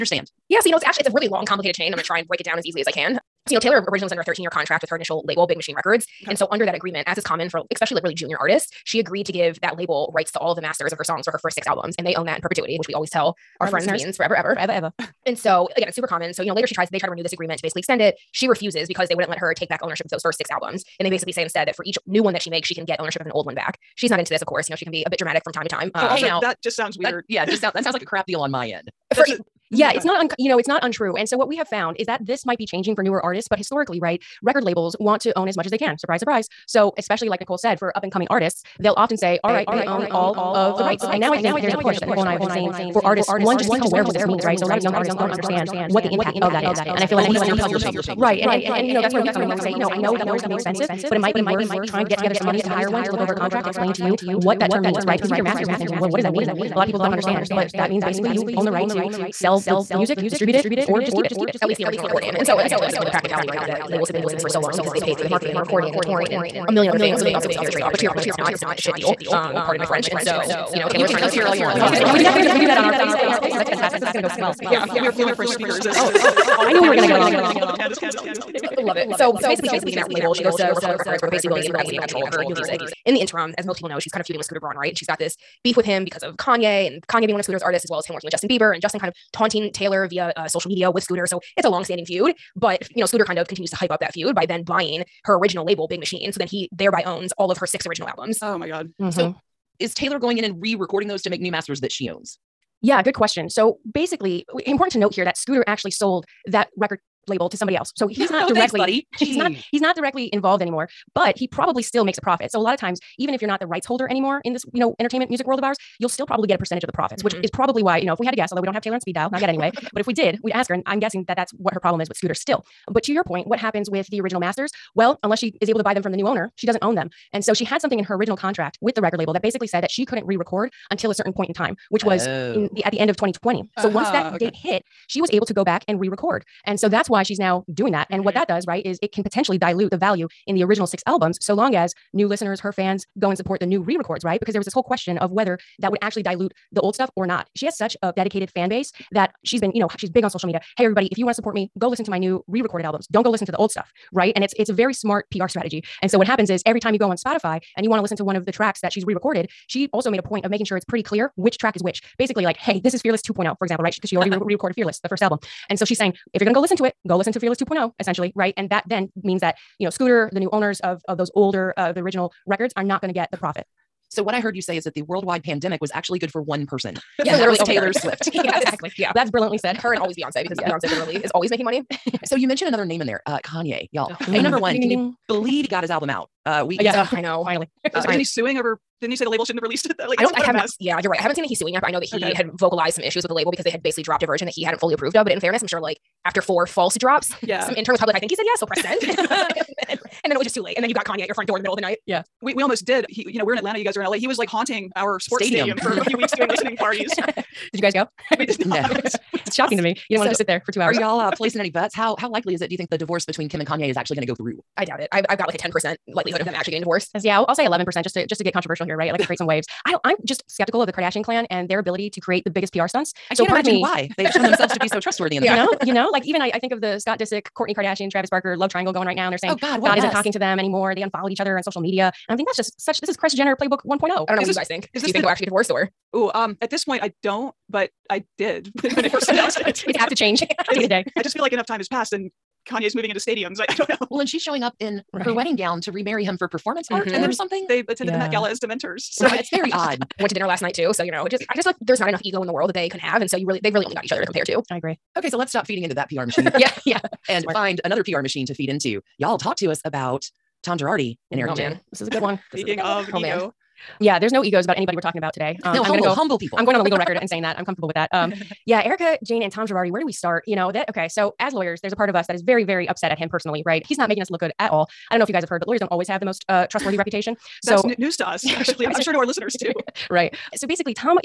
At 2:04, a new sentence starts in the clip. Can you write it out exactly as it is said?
Well, unless she is able to buy them from the new owner, she doesn't own them.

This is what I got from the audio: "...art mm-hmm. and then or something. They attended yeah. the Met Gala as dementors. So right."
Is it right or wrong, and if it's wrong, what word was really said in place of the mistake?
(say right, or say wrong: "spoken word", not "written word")
right.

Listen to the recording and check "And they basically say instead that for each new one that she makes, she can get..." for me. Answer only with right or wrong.
right.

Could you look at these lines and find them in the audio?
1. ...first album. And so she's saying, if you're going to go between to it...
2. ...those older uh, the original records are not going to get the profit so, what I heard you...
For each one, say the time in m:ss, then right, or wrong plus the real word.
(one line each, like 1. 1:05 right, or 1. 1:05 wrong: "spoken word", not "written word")
1. 2:45 wrong: "listen", not "between"
2. 2:51 right.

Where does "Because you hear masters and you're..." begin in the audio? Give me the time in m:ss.
0:55.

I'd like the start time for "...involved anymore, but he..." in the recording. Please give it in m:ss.
1:50.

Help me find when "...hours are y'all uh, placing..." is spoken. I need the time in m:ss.
3:30.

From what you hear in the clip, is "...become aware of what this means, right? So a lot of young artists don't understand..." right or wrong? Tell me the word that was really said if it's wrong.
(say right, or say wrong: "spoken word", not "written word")
right.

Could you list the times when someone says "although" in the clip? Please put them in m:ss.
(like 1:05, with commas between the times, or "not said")
1:58.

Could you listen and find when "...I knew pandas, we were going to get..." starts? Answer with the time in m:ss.
1:16.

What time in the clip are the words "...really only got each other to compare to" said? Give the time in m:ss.
4:13.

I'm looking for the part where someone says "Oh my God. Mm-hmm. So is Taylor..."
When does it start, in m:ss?
1:38.